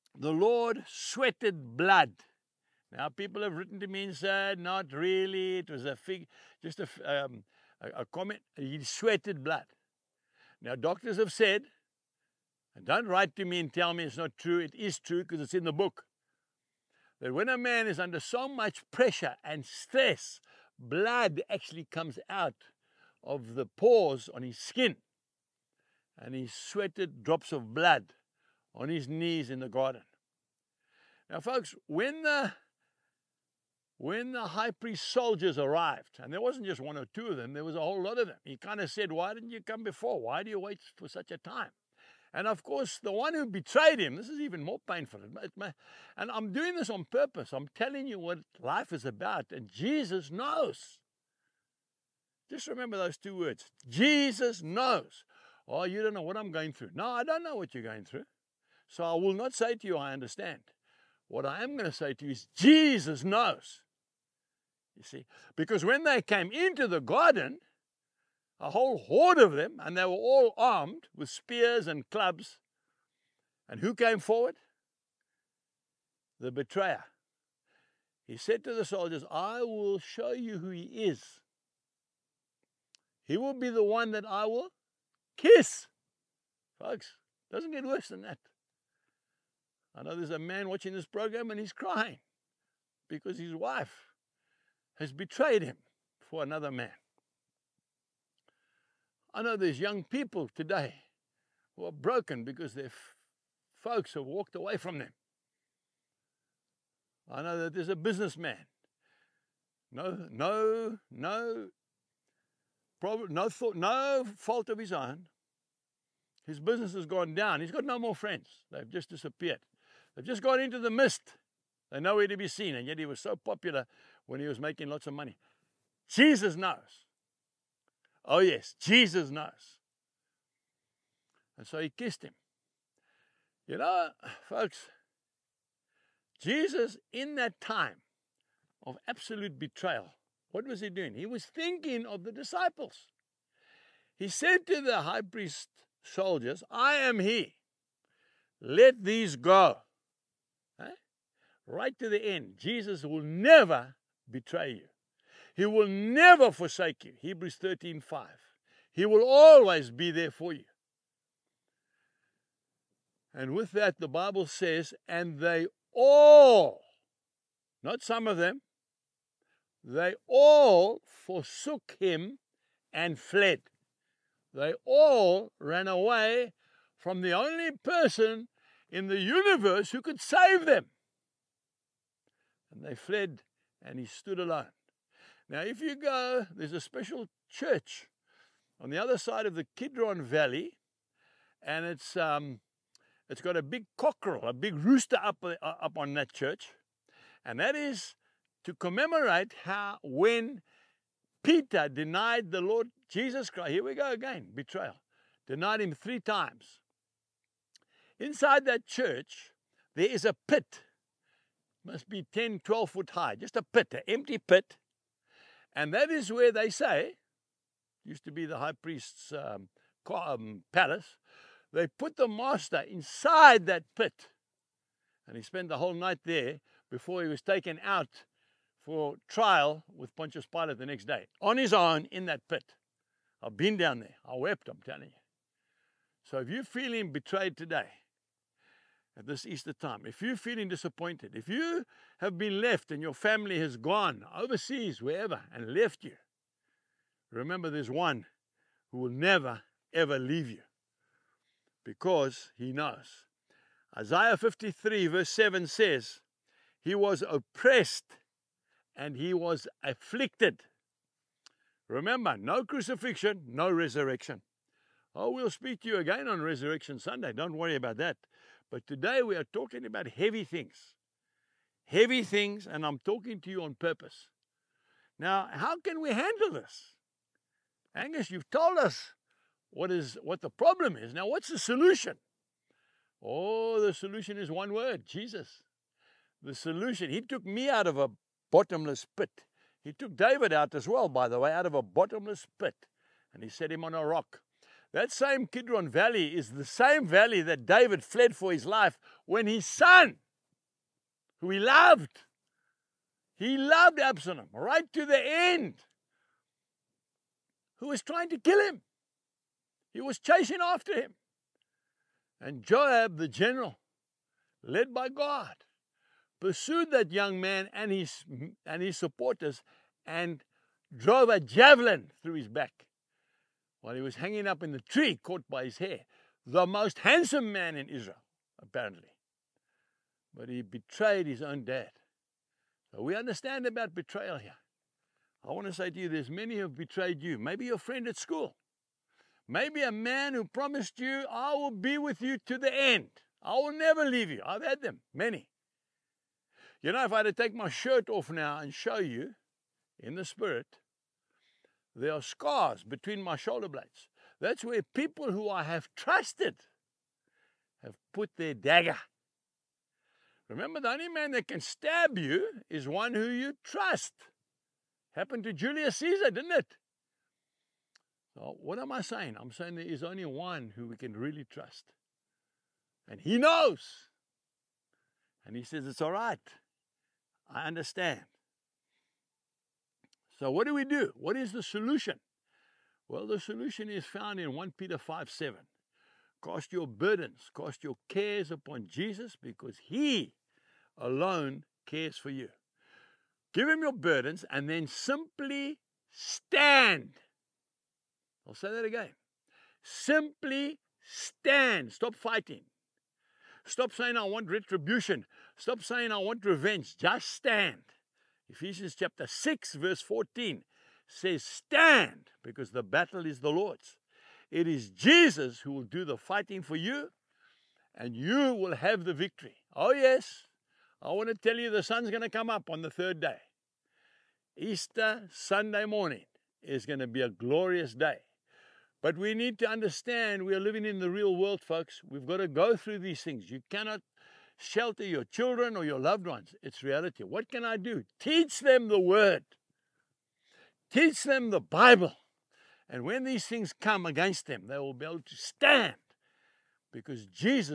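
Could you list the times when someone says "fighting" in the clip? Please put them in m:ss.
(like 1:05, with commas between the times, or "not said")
6:42, 6:56.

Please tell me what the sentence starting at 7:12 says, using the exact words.
We've got to go through these things.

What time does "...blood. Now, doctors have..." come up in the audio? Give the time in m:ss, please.
0:09.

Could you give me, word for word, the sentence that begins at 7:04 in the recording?
Easter Sunday morning is going to be a glorious day.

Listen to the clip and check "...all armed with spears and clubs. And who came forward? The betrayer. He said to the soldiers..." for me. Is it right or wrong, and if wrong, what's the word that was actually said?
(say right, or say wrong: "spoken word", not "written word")
right.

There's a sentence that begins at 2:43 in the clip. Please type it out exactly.
And with that, the Bible says, and they all, not some of them, they all forsook him and fled.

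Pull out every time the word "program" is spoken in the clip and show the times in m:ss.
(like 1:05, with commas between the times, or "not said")
1:31.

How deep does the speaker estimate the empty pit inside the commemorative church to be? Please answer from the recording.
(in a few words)
10 to 12 feet.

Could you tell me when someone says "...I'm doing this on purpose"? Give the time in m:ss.
0:46.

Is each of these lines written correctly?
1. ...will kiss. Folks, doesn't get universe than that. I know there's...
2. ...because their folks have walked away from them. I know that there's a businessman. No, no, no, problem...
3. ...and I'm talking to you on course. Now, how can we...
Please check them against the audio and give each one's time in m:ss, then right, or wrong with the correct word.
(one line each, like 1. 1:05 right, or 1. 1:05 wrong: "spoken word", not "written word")
1. 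1:24 wrong: "worse", not "universe"
2. 1:42 right
3. 4:32 wrong: "purpose", not "course".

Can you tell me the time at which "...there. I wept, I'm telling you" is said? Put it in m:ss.
3:54.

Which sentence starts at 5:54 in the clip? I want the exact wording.
That's where people who I have trusted have put their dagger.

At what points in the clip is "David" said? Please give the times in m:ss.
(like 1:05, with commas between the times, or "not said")
4:50, 4:57.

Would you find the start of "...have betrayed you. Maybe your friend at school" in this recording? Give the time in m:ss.
5:36.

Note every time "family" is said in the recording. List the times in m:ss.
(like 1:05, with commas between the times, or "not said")
4:03.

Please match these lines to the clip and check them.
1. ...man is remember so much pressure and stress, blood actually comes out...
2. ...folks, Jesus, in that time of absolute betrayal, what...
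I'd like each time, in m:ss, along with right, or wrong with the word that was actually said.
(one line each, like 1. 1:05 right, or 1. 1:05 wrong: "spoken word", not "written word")
1. 0:17 wrong: "under", not "remember"
2. 2:14 right.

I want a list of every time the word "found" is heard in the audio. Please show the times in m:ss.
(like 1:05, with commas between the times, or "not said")
6:24.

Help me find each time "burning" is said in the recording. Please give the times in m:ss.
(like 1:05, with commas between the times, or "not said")
not said.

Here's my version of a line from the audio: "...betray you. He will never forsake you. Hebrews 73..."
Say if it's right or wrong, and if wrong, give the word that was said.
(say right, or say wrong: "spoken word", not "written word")
wrong: "13", not "73".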